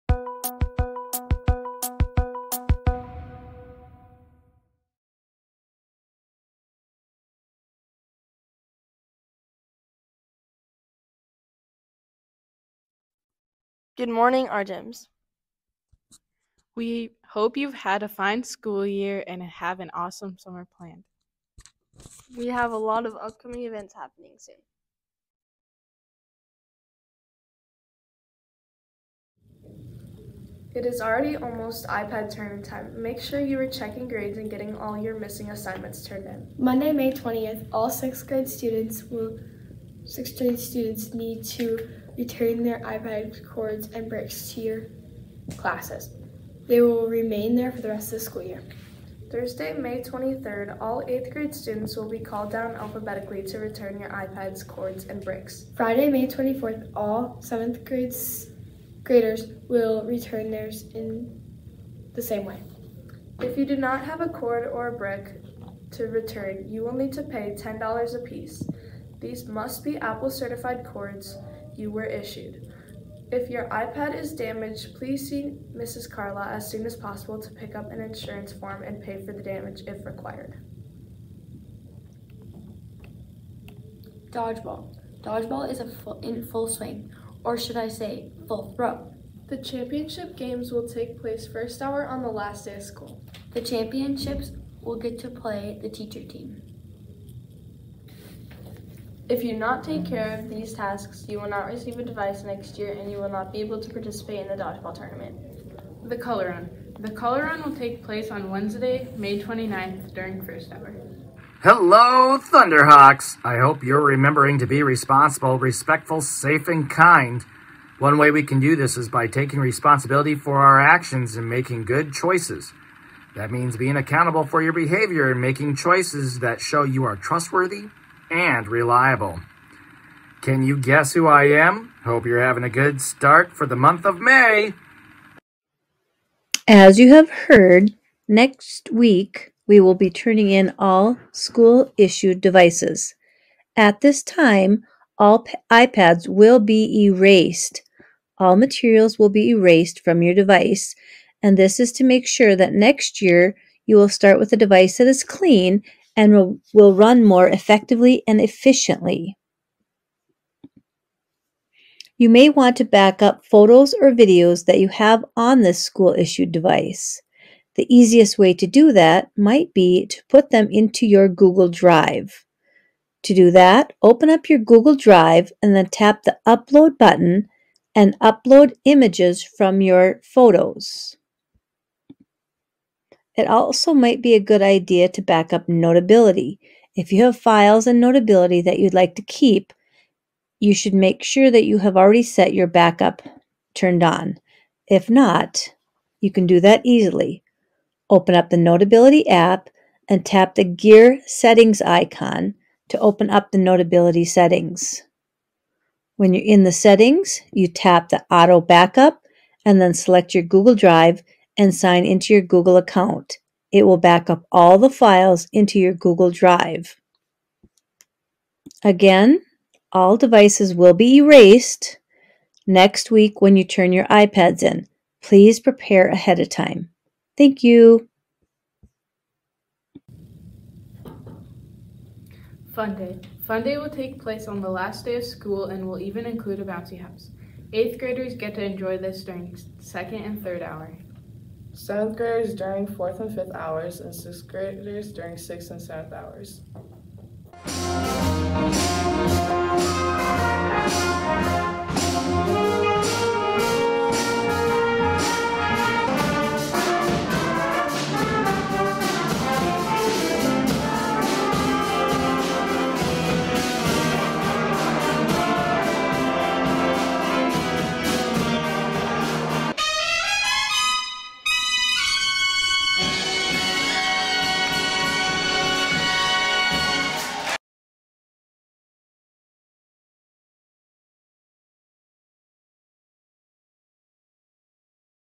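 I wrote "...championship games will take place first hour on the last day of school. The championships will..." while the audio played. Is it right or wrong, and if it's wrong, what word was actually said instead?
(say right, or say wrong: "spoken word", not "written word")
right.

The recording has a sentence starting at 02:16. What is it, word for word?
As you have heard, next week we will be turning in all school issued devices.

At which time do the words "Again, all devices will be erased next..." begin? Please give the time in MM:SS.
03:38.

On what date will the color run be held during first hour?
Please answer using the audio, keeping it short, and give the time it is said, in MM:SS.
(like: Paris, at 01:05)
Wednesday, May 29th, at 01:48.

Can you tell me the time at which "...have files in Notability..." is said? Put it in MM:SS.
03:07.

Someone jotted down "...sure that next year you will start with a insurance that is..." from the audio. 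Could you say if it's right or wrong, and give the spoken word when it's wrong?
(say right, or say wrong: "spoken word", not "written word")
wrong: "device", not "insurance".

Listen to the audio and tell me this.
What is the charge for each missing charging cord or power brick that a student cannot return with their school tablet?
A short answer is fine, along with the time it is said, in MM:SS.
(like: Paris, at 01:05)
$10, at 01:07.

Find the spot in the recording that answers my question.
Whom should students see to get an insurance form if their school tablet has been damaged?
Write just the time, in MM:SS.
01:15.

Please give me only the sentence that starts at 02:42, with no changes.
You may want to back up photos or videos that you have on this school-issued device.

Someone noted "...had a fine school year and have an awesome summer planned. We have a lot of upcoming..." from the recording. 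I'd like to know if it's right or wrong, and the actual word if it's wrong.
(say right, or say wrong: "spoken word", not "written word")
right.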